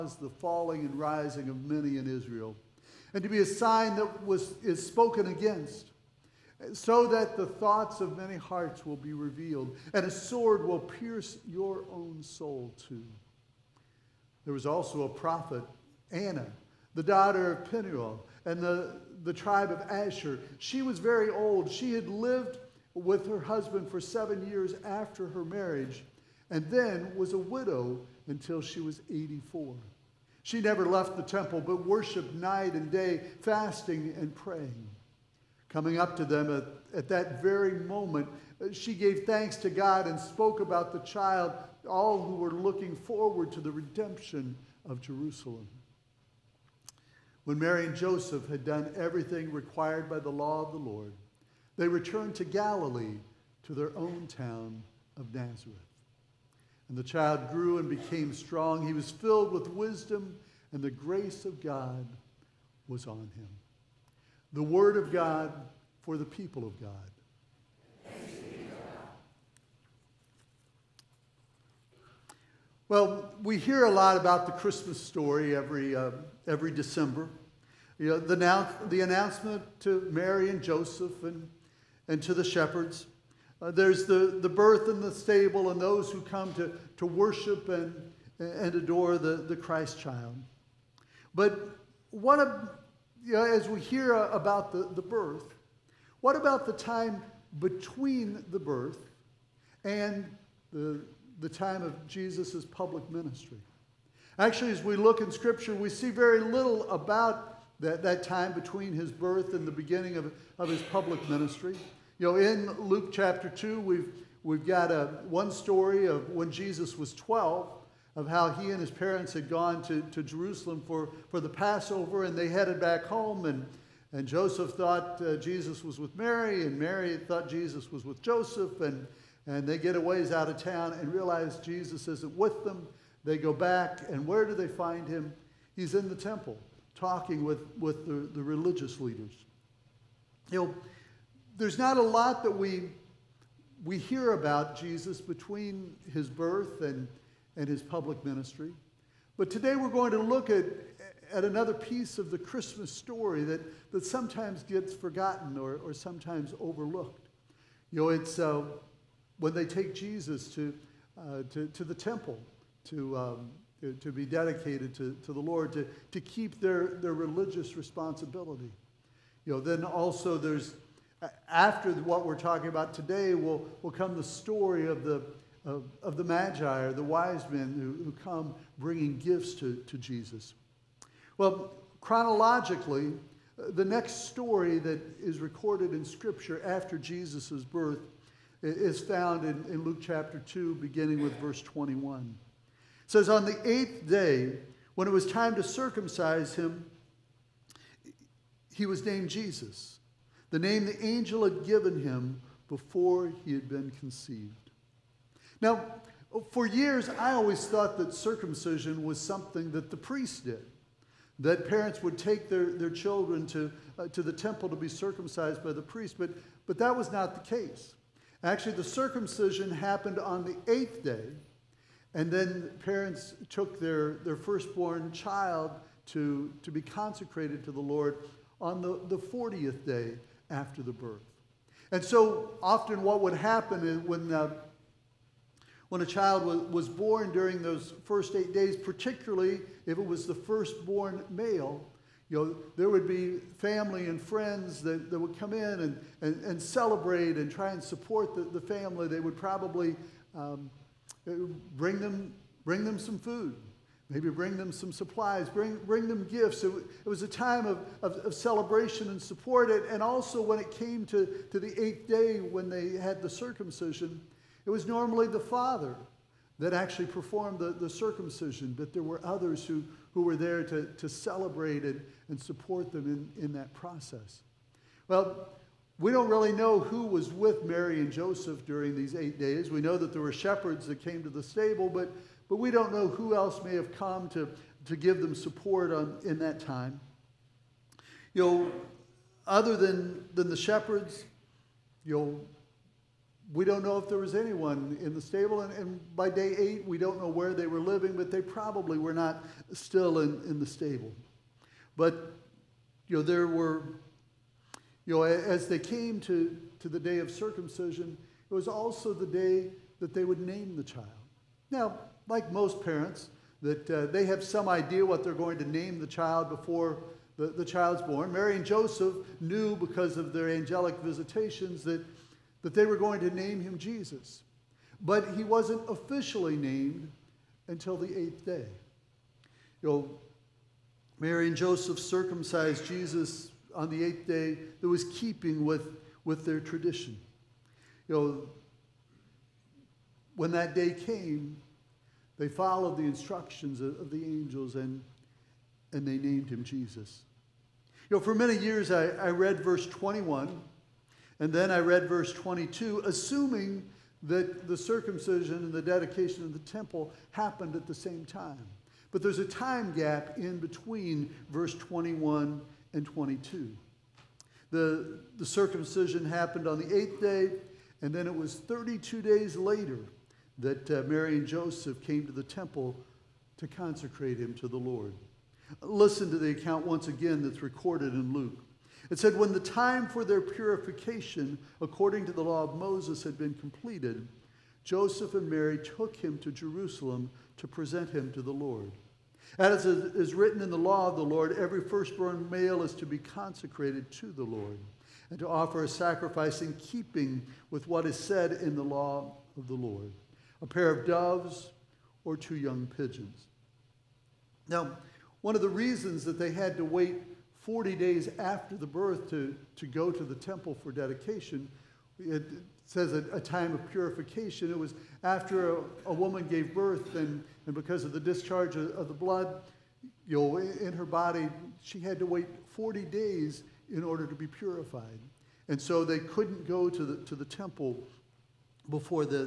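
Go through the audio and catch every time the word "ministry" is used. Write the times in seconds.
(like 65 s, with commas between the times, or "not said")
103 s, 111 s, 148 s.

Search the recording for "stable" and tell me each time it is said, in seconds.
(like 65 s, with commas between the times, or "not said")
85 s, 281 s, 295 s, 300 s.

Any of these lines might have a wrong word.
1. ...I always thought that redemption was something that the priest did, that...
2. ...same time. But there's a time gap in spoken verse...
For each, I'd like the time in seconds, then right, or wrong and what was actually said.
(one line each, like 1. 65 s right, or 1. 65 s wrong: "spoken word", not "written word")
1. 207 s wrong: "circumcision", not "redemption"
2. 357 s wrong: "between", not "spoken".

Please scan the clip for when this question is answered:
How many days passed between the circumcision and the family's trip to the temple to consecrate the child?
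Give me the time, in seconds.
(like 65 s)
368 s.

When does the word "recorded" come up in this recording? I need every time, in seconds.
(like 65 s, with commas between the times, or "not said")
185 s, 377 s.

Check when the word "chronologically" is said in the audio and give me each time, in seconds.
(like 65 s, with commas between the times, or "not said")
181 s.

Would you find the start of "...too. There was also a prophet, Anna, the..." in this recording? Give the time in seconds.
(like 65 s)
12 s.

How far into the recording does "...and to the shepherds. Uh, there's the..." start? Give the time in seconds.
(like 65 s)
82 s.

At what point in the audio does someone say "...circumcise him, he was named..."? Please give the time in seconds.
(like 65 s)
195 s.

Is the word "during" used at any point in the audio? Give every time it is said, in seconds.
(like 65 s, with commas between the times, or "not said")
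237 s, 278 s.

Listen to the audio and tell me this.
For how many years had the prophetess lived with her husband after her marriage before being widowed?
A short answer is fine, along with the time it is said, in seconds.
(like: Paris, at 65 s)
7, at 23 s.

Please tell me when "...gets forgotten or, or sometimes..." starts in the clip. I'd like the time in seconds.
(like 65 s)
154 s.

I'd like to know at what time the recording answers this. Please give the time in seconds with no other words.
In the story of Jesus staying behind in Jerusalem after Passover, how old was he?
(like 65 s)
117 s.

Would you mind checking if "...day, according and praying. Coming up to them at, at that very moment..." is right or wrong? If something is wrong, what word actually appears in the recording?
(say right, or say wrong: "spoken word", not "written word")
wrong: "fasting", not "according".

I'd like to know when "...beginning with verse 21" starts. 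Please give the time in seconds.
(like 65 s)
190 s.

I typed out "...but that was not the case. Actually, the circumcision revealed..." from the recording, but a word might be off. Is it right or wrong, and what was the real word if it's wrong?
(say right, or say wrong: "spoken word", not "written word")
wrong: "happened", not "revealed".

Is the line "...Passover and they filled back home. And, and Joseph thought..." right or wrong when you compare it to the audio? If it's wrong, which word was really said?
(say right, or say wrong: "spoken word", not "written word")
wrong: "headed", not "filled".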